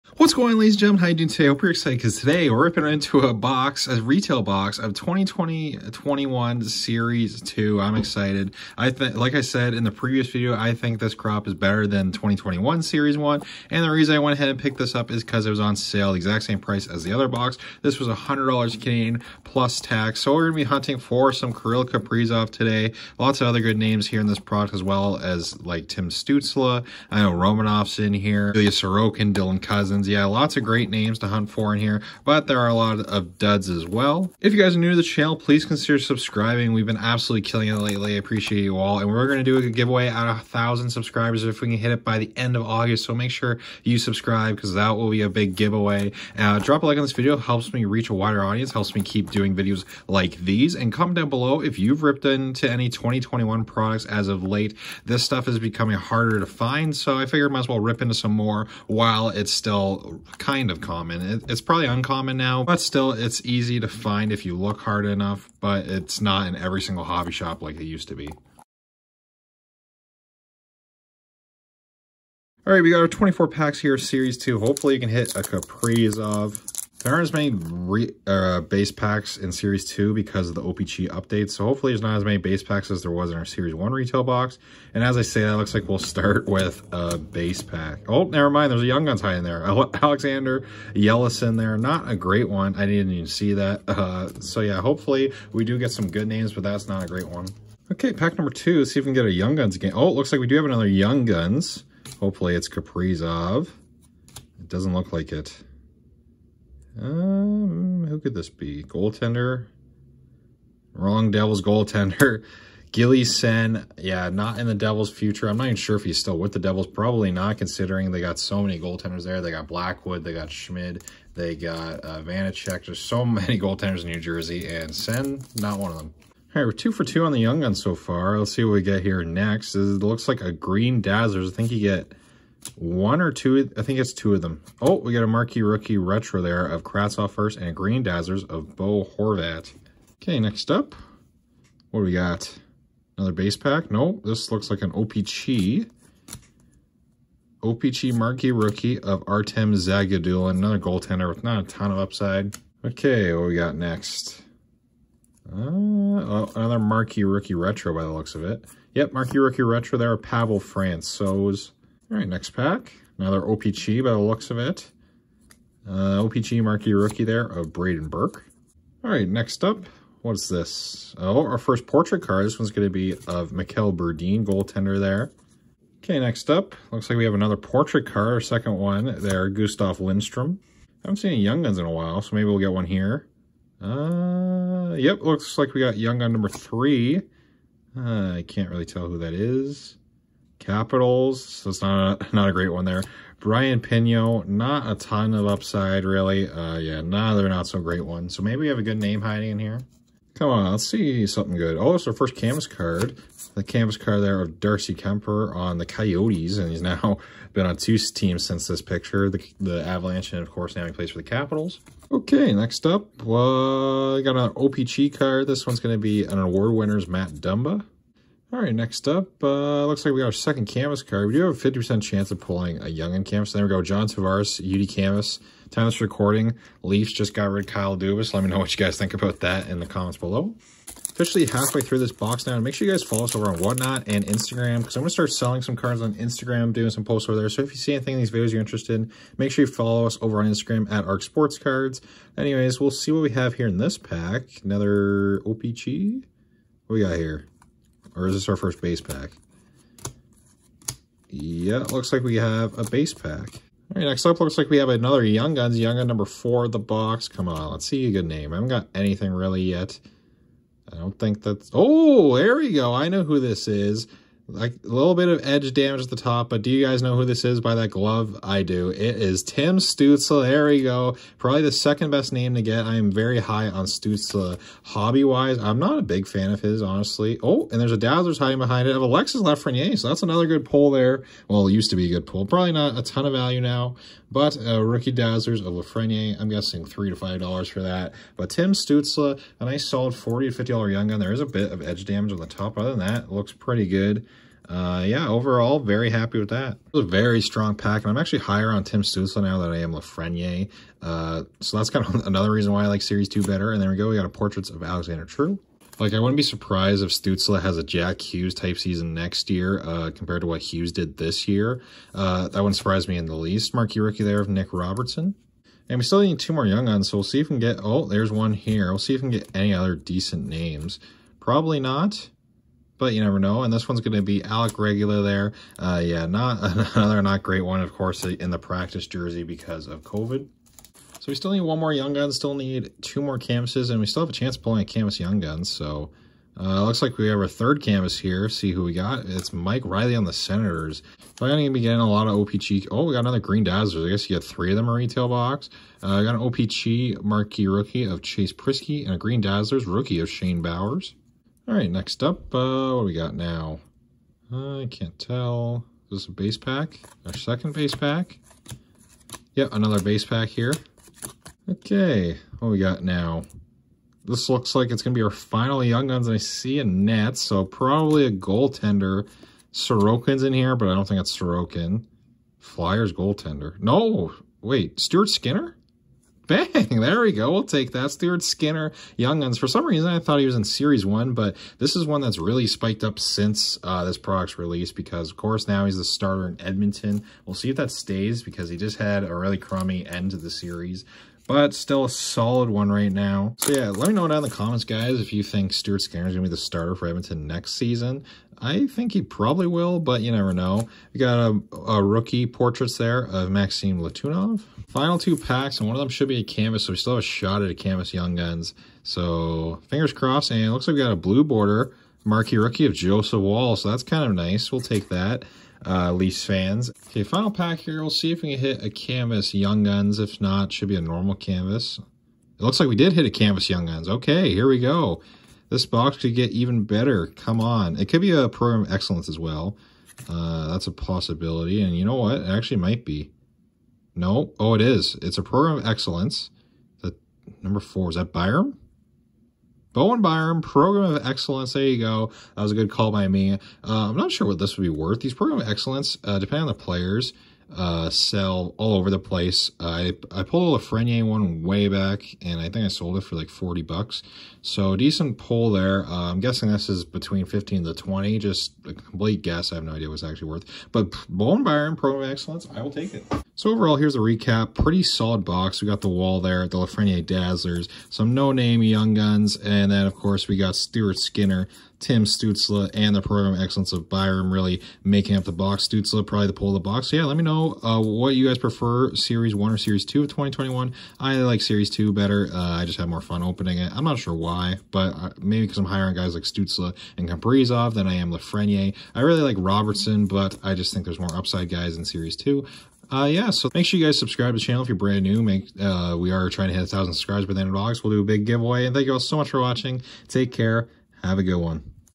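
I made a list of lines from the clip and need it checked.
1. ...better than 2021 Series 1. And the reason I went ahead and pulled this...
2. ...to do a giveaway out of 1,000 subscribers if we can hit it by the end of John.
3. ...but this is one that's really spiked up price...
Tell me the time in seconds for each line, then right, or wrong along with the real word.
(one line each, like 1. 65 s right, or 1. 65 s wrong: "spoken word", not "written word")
1. 11 s wrong: "picked", not "pulled"
2. 39 s wrong: "August", not "John"
3. 381 s wrong: "since", not "price".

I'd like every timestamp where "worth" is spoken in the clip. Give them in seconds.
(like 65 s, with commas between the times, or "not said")
444 s, 460 s.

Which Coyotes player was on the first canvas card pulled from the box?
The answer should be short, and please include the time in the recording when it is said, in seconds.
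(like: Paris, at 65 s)
Darcy Kuemper, at 204 s.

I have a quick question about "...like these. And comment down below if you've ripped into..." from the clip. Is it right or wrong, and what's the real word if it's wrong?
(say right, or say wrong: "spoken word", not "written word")
right.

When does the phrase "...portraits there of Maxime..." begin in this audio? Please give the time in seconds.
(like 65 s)
402 s.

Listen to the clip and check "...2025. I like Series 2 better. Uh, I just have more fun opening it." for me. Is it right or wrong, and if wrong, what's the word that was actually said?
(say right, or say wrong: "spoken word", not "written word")
wrong: "2021", not "2025".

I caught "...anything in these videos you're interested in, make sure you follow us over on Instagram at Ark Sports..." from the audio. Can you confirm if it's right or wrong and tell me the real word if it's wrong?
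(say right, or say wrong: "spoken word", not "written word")
right.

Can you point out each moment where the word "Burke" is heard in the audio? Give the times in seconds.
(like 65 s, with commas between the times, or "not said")
168 s.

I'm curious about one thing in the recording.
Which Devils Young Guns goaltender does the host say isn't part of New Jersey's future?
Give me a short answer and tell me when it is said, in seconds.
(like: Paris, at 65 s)
Gilly Senn, at 112 s.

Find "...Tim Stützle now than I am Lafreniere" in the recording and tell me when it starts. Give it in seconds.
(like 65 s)
298 s.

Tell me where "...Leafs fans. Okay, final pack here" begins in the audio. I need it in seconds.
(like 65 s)
416 s.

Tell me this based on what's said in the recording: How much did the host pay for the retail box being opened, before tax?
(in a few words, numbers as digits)
$100 Canadian.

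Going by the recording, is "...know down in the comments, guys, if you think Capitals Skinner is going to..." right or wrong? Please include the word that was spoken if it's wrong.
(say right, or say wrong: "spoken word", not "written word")
wrong: "Stuart", not "Capitals".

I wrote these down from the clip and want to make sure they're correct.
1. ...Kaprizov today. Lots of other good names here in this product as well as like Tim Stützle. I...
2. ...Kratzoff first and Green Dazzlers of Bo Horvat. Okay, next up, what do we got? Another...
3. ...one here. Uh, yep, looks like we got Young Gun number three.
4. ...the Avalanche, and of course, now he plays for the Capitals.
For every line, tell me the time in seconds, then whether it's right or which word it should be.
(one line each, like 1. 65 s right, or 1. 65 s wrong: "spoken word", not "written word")
1. 21 s right
2. 136 s right
3. 182 s right
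4. 209 s right.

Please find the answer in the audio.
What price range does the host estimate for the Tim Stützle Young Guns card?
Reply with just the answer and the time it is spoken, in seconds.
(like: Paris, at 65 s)
$40 to $50, at 290 s.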